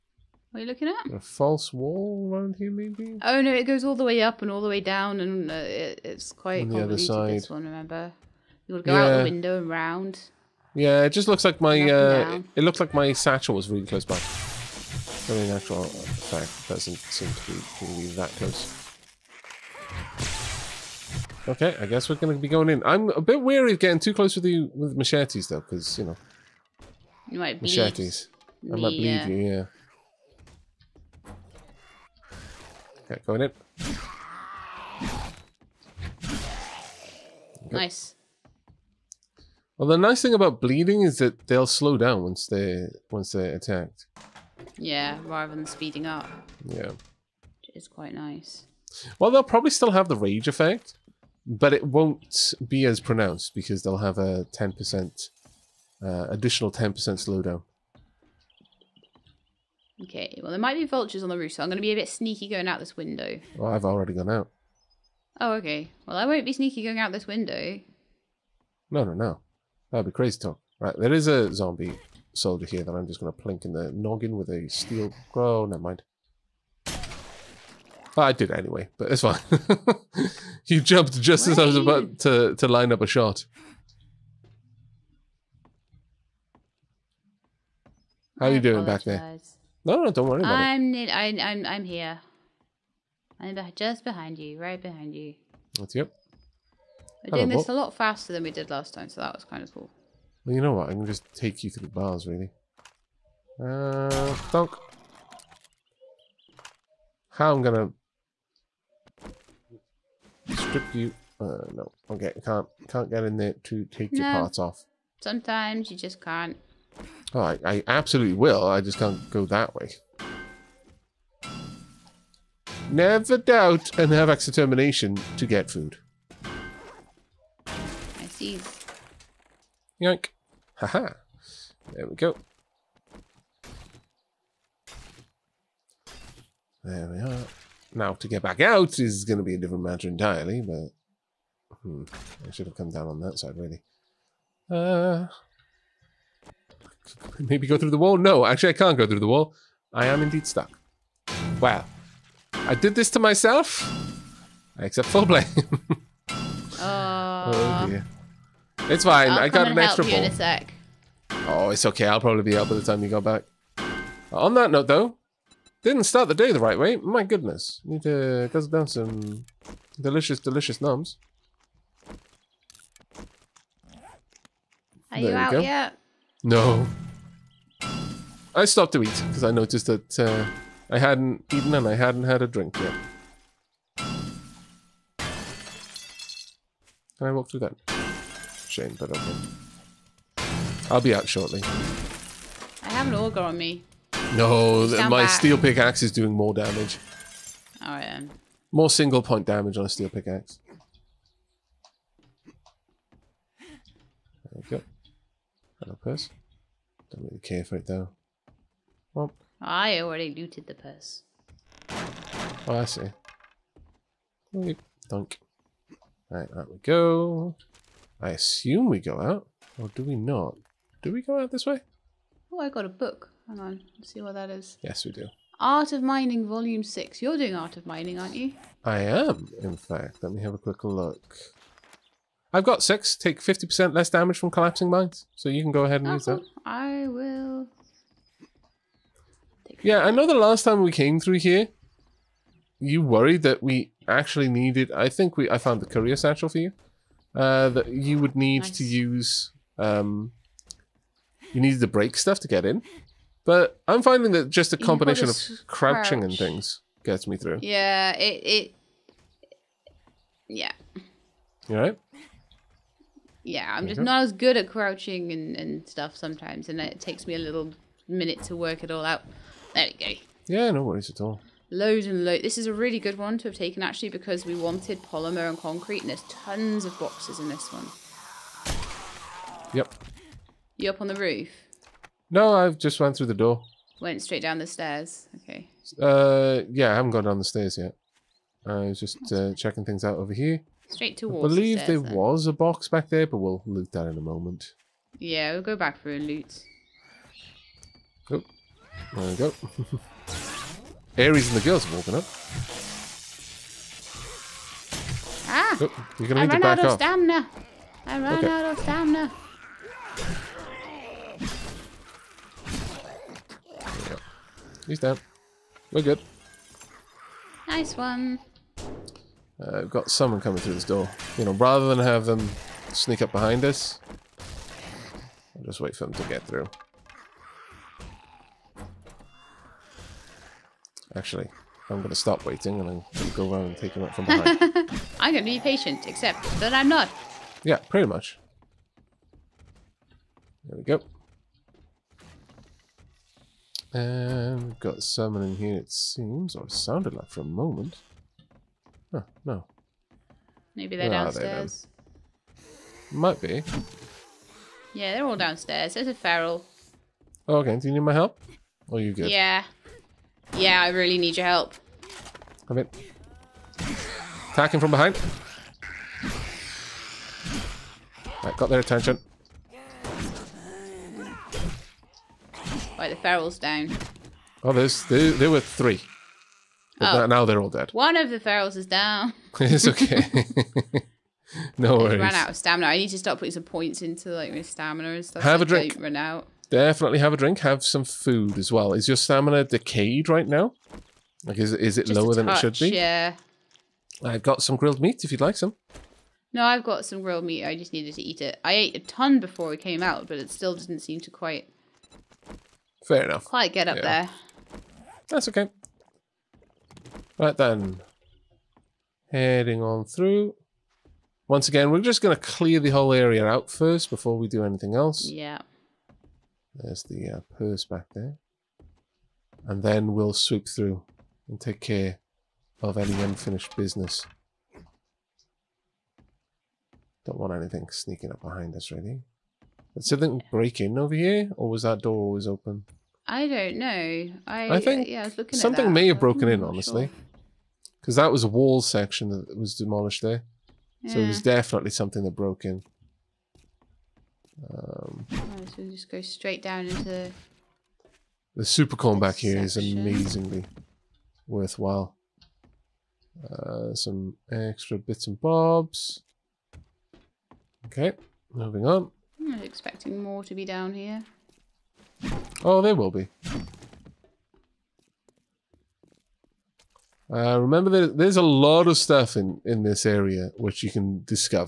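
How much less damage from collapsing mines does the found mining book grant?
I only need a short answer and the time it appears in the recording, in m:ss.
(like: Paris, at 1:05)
50%, at 3:53.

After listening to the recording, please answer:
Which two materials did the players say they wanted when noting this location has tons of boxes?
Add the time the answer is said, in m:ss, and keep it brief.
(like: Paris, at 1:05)
polymer and concrete, at 4:35.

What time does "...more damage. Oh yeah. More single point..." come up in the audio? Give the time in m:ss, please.
3:16.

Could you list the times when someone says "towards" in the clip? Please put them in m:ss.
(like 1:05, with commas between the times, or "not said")
4:51.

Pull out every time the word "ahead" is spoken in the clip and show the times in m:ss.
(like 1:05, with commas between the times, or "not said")
3:55.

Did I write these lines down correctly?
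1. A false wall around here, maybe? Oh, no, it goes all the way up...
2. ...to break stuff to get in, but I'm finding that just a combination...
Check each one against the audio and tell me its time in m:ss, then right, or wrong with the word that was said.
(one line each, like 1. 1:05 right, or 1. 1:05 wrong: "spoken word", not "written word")
1. 0:01 right
2. 4:11 right.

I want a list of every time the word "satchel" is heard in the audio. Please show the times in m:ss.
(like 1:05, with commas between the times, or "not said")
0:13, 4:06.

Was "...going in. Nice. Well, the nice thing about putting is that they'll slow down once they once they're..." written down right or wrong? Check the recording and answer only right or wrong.
wrong.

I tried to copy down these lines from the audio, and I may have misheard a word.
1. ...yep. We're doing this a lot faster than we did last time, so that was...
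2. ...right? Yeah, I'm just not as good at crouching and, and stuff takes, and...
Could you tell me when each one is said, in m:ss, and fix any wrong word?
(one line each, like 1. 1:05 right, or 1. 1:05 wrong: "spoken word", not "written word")
1. 1:35 right
2. 4:21 wrong: "sometimes", not "takes".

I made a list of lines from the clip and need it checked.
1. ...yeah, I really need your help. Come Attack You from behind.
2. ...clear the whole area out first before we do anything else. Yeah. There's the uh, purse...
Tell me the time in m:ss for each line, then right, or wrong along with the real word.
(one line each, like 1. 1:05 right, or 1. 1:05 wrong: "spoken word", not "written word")
1. 6:00 wrong: "Attacking", not "You"
2. 6:52 right.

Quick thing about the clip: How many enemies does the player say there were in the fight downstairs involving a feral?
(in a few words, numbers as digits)
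3.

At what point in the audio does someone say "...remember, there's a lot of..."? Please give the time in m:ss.
7:47.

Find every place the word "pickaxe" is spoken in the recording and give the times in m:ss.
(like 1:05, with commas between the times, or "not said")
3:15, 3:20.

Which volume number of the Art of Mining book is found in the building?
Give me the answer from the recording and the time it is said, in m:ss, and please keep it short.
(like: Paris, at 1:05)
6, at 3:46.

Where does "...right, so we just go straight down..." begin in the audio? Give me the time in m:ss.
7:25.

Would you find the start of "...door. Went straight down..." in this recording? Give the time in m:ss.
4:43.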